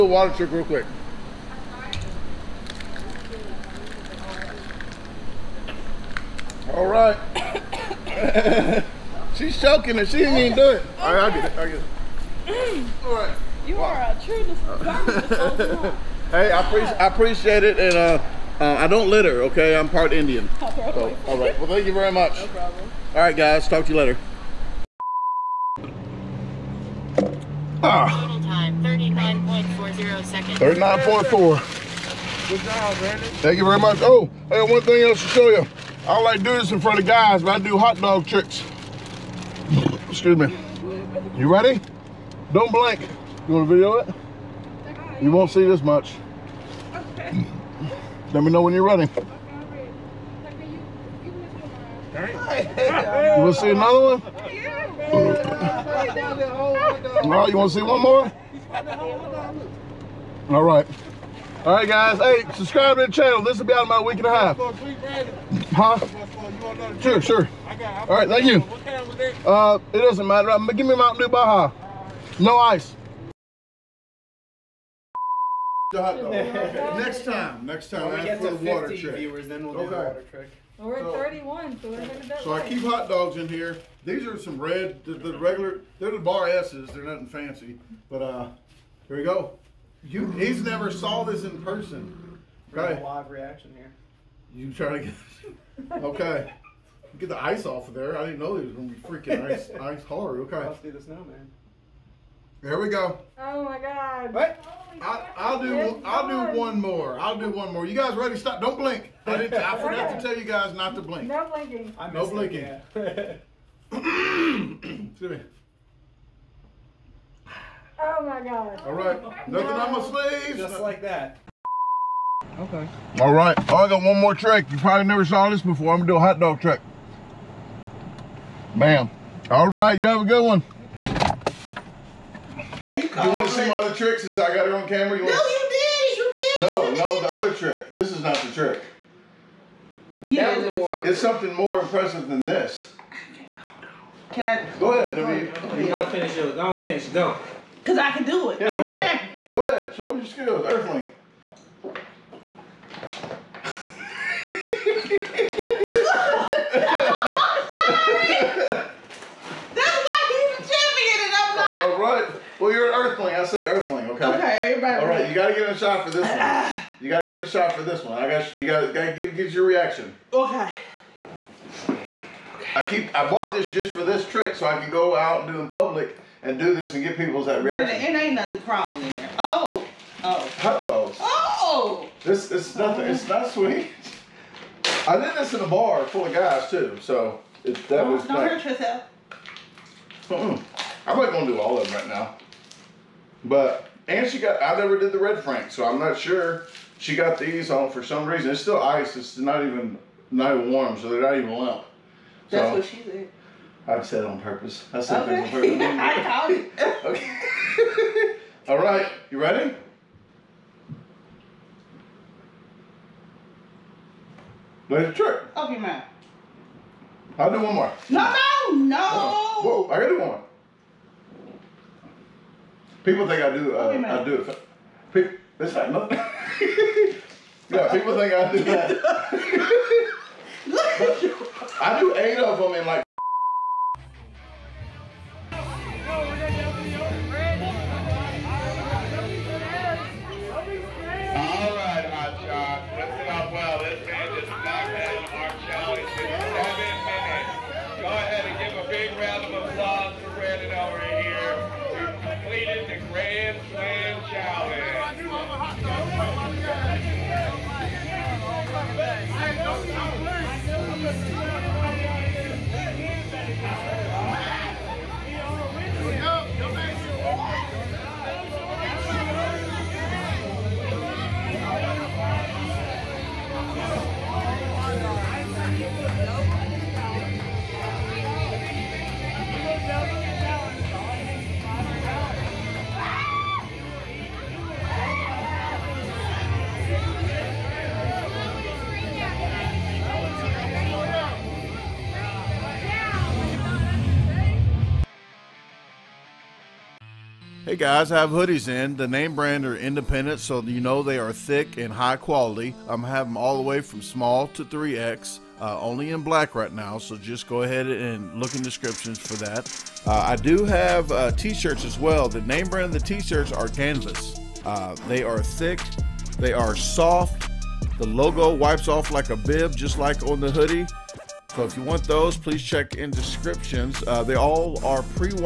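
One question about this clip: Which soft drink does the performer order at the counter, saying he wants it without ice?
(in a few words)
Mountain Dew Baja.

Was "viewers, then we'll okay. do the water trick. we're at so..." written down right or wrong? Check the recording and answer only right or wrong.
right.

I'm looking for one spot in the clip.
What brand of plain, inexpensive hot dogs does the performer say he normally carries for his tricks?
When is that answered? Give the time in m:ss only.
1:26.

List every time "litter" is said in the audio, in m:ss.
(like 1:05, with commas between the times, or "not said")
0:19.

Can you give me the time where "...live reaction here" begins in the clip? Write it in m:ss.
1:33.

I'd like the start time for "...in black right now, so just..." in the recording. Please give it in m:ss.
5:06.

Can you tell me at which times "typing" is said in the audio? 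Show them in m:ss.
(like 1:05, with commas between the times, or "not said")
not said.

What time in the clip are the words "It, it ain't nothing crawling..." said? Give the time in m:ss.
2:58.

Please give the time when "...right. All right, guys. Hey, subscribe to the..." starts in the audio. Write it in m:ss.
1:00.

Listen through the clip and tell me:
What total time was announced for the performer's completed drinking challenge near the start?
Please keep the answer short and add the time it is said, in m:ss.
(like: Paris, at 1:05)
39.4 seconds, at 0:30.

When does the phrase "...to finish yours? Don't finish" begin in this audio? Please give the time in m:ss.
2:26.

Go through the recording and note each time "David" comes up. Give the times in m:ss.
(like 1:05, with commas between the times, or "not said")
2:25.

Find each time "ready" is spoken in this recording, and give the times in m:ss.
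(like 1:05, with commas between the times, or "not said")
0:41, 0:48, 1:48, 3:29.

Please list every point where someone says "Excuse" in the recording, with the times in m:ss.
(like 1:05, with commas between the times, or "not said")
0:40, 1:53.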